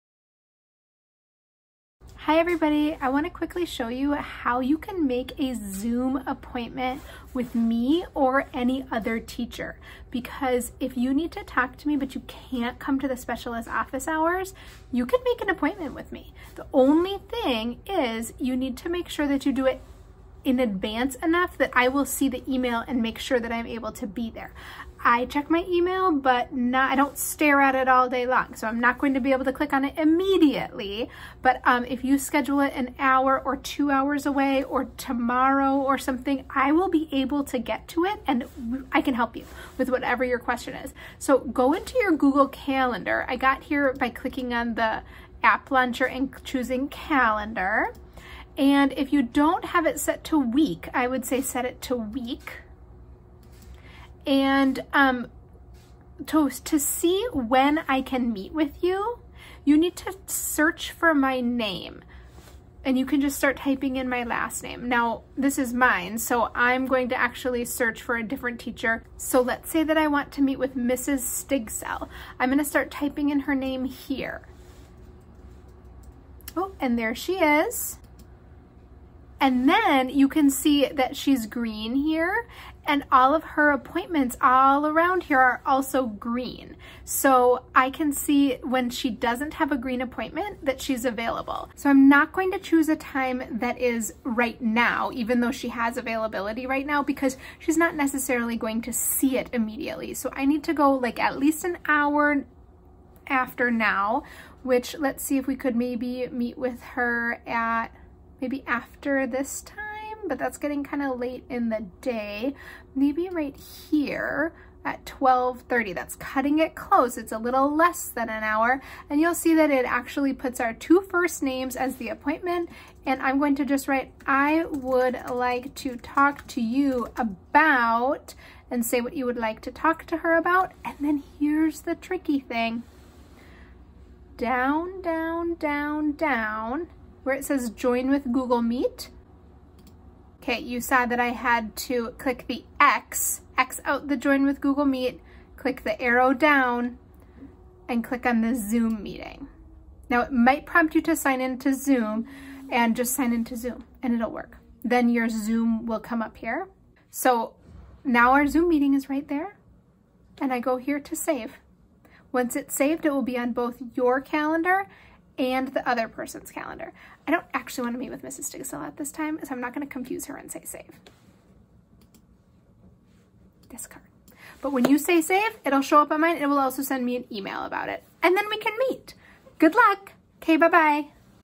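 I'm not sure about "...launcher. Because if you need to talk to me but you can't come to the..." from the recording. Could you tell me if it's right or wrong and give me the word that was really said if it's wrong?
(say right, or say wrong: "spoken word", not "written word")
wrong: "teacher", not "launcher".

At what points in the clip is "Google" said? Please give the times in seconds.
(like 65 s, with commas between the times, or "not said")
42 s, 138 s, 144 s.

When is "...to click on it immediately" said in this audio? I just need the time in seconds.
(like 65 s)
29 s.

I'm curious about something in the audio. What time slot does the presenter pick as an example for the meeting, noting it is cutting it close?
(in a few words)
12:30.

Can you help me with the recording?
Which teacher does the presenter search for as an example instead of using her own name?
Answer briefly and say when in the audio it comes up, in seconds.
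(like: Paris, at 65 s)
Mrs. Stigcell, at 70 s.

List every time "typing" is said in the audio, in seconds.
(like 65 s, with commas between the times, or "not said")
63 s, 72 s.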